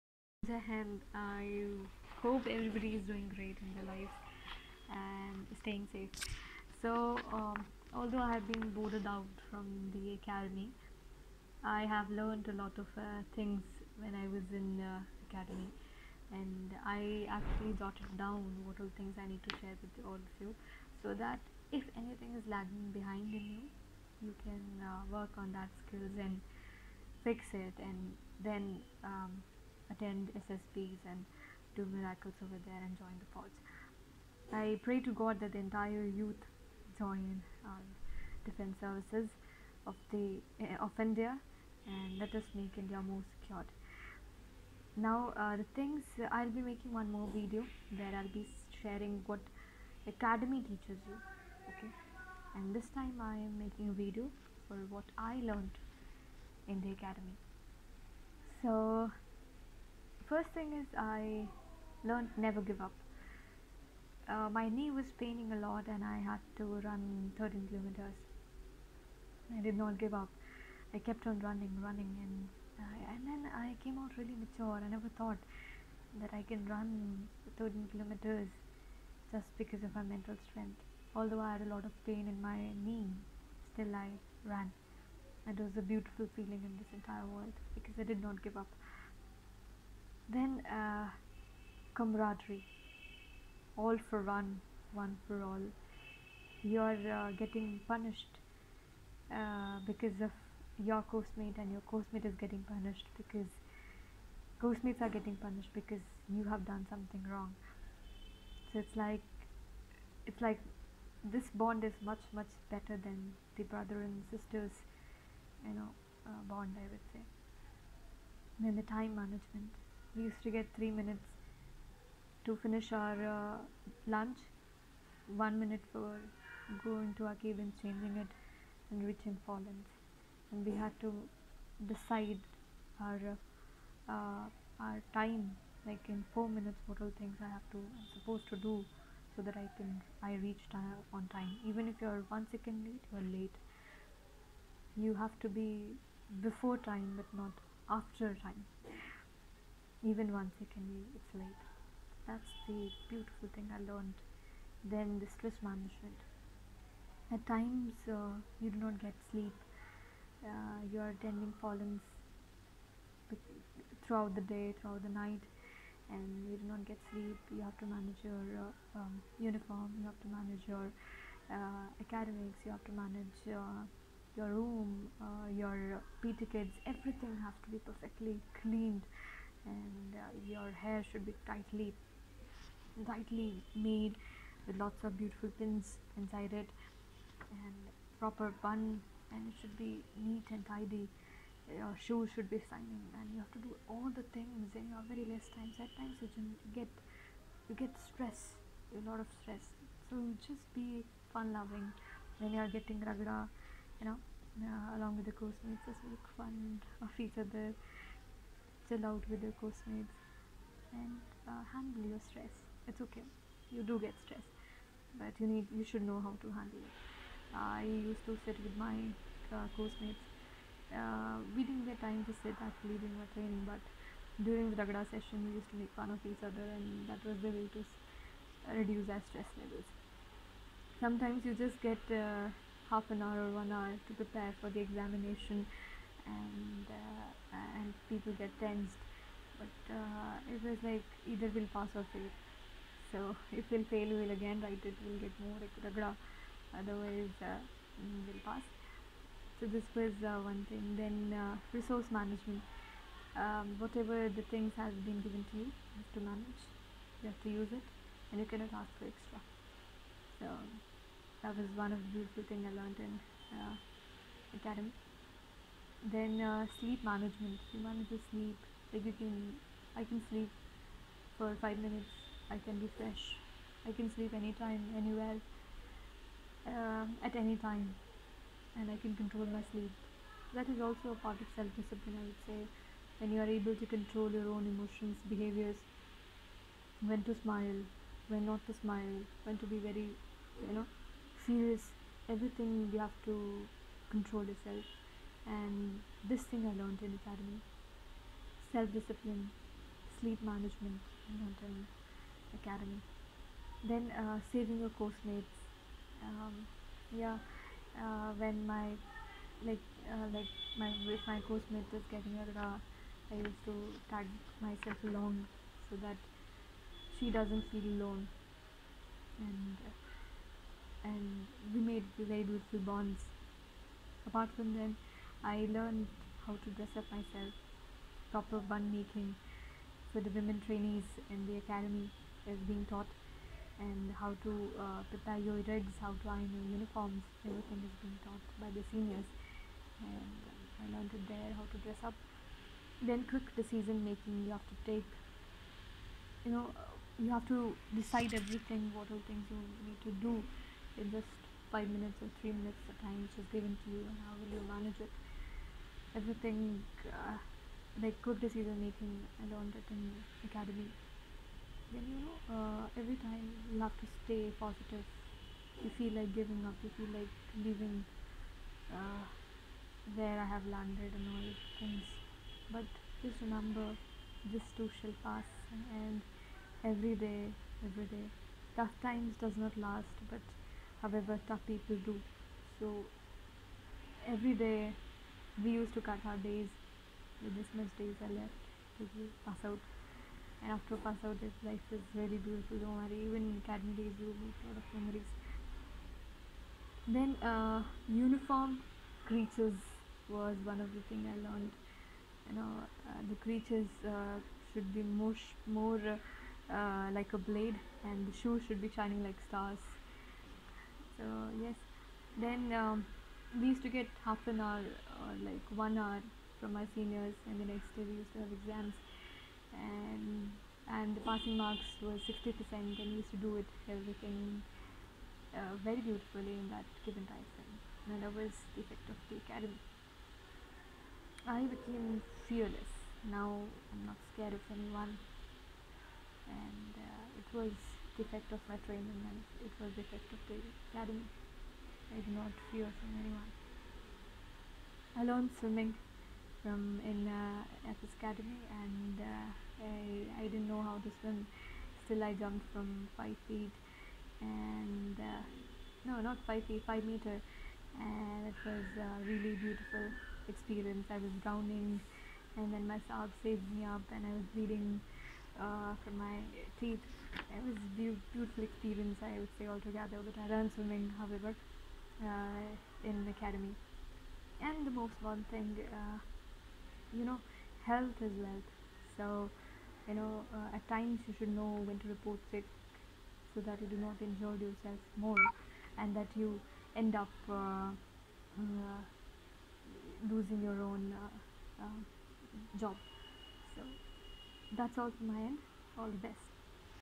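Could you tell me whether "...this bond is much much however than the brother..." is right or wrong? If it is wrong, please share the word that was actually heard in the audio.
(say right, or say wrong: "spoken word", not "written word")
wrong: "better", not "however".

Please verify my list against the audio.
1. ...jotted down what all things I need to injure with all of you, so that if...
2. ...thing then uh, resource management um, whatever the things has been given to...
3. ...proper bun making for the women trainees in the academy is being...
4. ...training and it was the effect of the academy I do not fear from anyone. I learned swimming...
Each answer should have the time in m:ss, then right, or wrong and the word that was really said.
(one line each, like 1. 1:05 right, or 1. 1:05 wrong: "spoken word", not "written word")
1. 0:17 wrong: "share", not "injure"
2. 4:10 right
3. 5:28 right
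4. 7:18 right.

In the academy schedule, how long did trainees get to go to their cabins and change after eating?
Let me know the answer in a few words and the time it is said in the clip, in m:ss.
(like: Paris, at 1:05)
1 minute, at 2:05.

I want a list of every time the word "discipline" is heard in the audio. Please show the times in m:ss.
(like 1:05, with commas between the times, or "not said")
4:41, 4:58.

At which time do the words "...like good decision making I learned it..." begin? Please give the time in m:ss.
5:58.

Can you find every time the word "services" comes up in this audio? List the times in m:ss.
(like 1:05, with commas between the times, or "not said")
0:38.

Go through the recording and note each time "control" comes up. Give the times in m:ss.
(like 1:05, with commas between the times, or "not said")
4:39, 4:43, 4:54.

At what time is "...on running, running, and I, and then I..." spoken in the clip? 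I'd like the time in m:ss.
1:11.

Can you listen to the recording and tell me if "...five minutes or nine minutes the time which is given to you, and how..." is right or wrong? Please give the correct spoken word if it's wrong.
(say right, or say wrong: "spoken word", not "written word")
wrong: "three", not "nine".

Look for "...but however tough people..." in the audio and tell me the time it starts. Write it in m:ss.
6:20.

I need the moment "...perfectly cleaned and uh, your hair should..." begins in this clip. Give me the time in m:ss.
2:57.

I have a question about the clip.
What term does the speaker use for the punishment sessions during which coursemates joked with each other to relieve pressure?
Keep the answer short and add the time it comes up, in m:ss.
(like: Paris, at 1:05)
ragda, at 3:44.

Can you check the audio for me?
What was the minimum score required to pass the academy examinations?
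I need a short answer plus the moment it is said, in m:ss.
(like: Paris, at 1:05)
60%, at 7:02.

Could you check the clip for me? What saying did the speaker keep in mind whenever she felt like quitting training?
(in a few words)
This too shall pass.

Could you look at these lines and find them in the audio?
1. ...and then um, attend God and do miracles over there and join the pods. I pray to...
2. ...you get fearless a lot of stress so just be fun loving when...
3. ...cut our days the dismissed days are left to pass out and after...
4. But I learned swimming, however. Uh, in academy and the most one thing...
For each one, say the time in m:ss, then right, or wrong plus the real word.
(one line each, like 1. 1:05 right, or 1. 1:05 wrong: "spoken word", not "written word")
1. 0:27 wrong: "SSBs", not "God"
2. 3:17 wrong: "stress", not "fearless"
3. 6:26 right
4. 7:50 right.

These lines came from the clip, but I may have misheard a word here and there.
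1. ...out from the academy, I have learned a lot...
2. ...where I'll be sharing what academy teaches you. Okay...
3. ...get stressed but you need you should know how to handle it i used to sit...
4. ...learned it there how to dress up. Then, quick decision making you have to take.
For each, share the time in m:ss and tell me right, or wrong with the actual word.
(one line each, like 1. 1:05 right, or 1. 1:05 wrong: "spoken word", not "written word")
1. 0:09 right
2. 0:47 right
3. 3:33 right
4. 5:40 right.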